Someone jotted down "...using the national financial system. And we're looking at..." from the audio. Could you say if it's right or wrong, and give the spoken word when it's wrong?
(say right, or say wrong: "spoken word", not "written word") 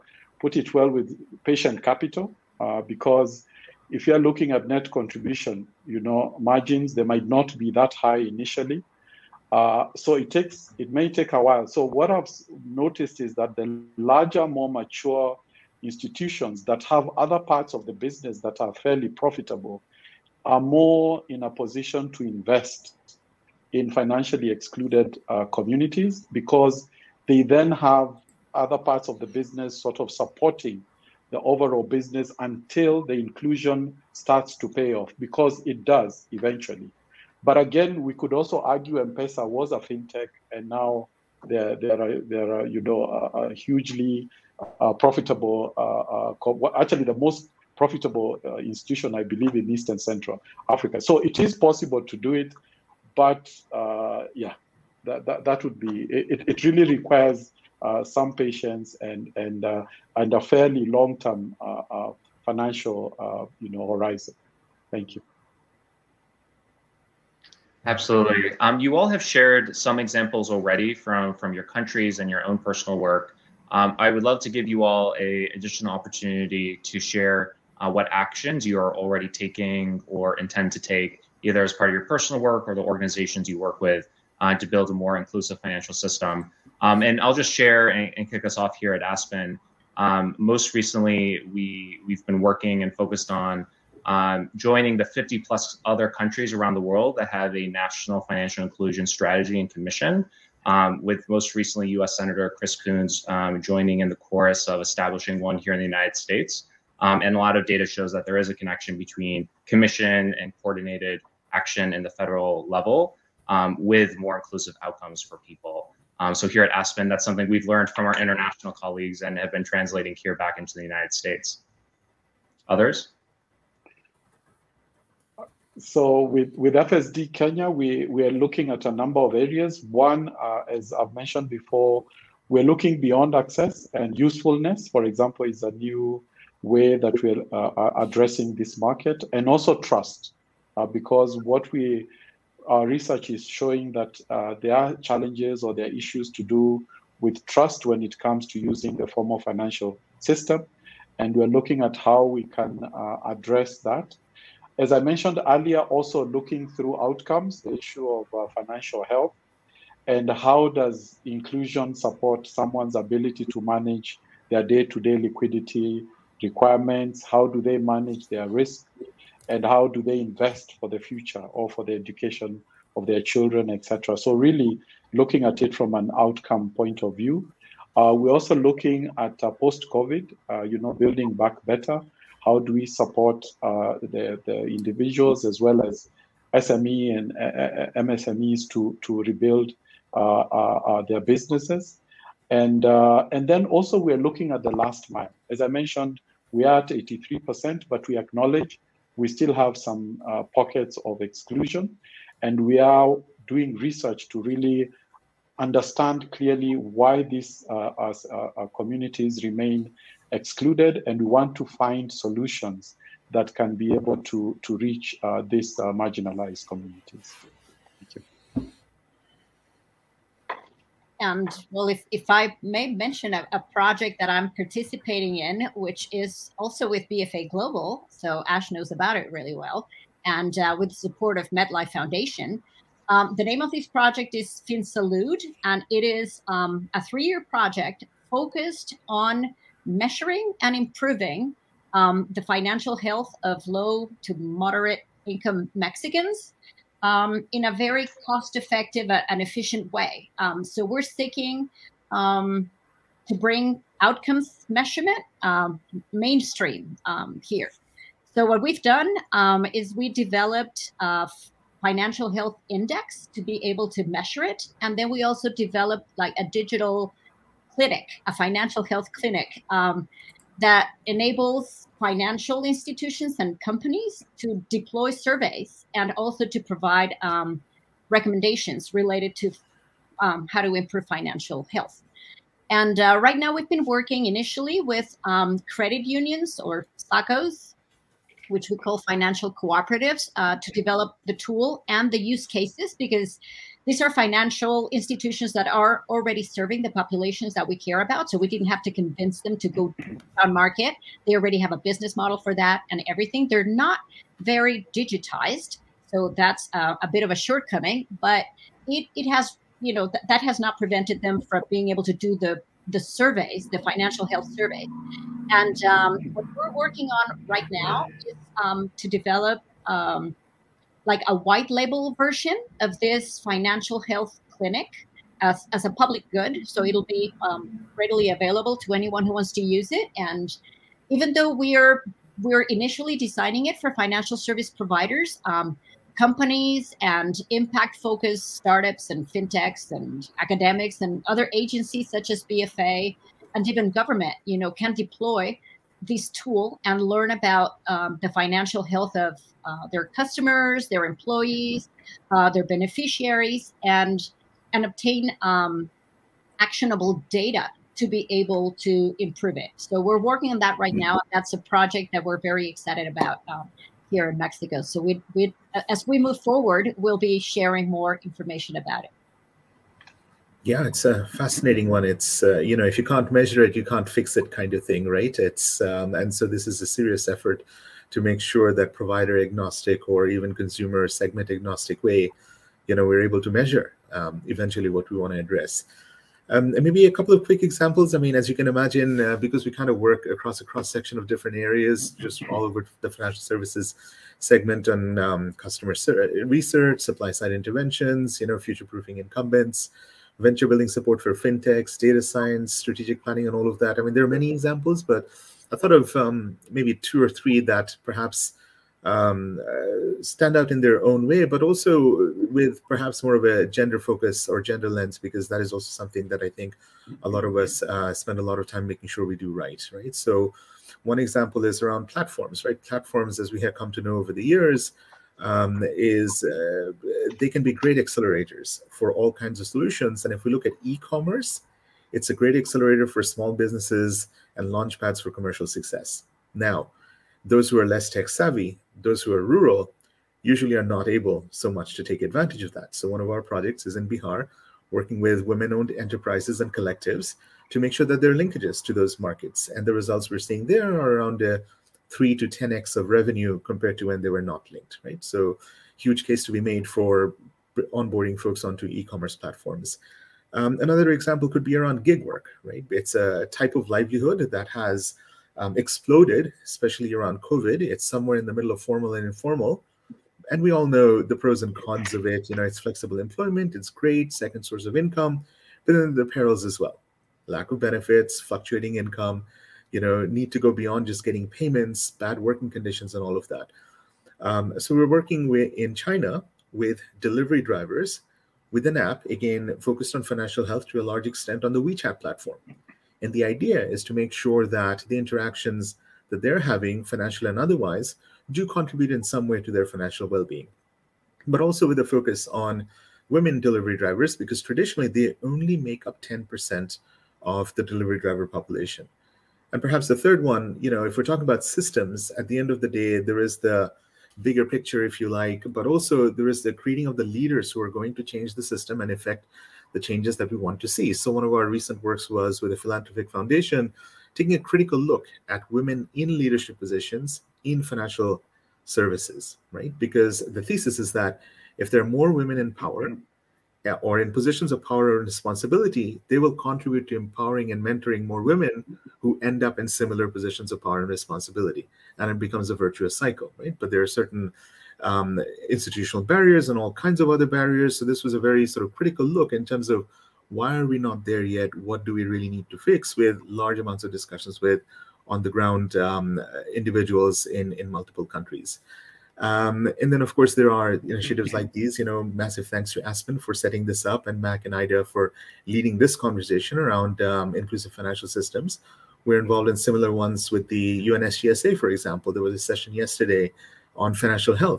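wrong: "formal", not "national".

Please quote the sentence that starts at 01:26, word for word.
Um, and I'll just share and, and, kick us off here at Aspen.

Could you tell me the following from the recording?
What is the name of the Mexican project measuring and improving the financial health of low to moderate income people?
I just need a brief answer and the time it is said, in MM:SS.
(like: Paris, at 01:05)
FinSalud, at 03:54.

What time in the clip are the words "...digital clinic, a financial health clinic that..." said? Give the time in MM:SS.
04:26.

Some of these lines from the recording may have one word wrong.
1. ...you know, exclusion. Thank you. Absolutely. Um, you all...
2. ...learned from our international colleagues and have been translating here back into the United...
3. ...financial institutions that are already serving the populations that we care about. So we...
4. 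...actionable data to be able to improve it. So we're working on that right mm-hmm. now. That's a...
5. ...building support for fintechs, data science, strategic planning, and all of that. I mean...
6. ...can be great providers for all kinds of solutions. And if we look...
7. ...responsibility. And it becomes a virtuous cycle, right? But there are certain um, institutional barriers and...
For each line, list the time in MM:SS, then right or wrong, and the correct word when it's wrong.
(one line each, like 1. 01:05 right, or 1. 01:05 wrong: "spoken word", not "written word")
1. 01:03 wrong: "horizon", not "exclusion"
2. 01:57 right
3. 04:54 right
4. 05:56 right
5. 06:40 right
6. 07:07 wrong: "accelerators", not "providers"
7. 09:01 right.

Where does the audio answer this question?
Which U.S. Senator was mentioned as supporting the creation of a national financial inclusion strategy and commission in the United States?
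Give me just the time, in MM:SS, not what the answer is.
01:42.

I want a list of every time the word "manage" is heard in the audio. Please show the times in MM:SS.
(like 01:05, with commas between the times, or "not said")
02:43, 02:47.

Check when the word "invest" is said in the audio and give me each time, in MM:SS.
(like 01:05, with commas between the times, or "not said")
00:22, 02:50.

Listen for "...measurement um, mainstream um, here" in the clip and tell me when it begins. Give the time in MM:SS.
04:14.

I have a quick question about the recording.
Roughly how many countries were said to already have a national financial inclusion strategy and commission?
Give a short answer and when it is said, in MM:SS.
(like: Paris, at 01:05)
50, at 01:35.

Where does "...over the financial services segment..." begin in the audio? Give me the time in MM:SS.
06:32.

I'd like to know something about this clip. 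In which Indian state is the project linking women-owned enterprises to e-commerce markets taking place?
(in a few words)
Bihar.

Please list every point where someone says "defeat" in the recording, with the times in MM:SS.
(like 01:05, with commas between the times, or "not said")
not said.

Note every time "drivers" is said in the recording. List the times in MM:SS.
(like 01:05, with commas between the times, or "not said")
08:07, 08:23, 08:28.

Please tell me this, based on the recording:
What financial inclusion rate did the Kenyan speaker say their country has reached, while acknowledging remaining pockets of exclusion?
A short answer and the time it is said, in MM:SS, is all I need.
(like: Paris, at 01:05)
83%, at 03:16.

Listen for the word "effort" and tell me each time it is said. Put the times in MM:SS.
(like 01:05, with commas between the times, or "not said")
06:17.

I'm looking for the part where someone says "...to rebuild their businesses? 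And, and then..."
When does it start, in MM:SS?
03:09.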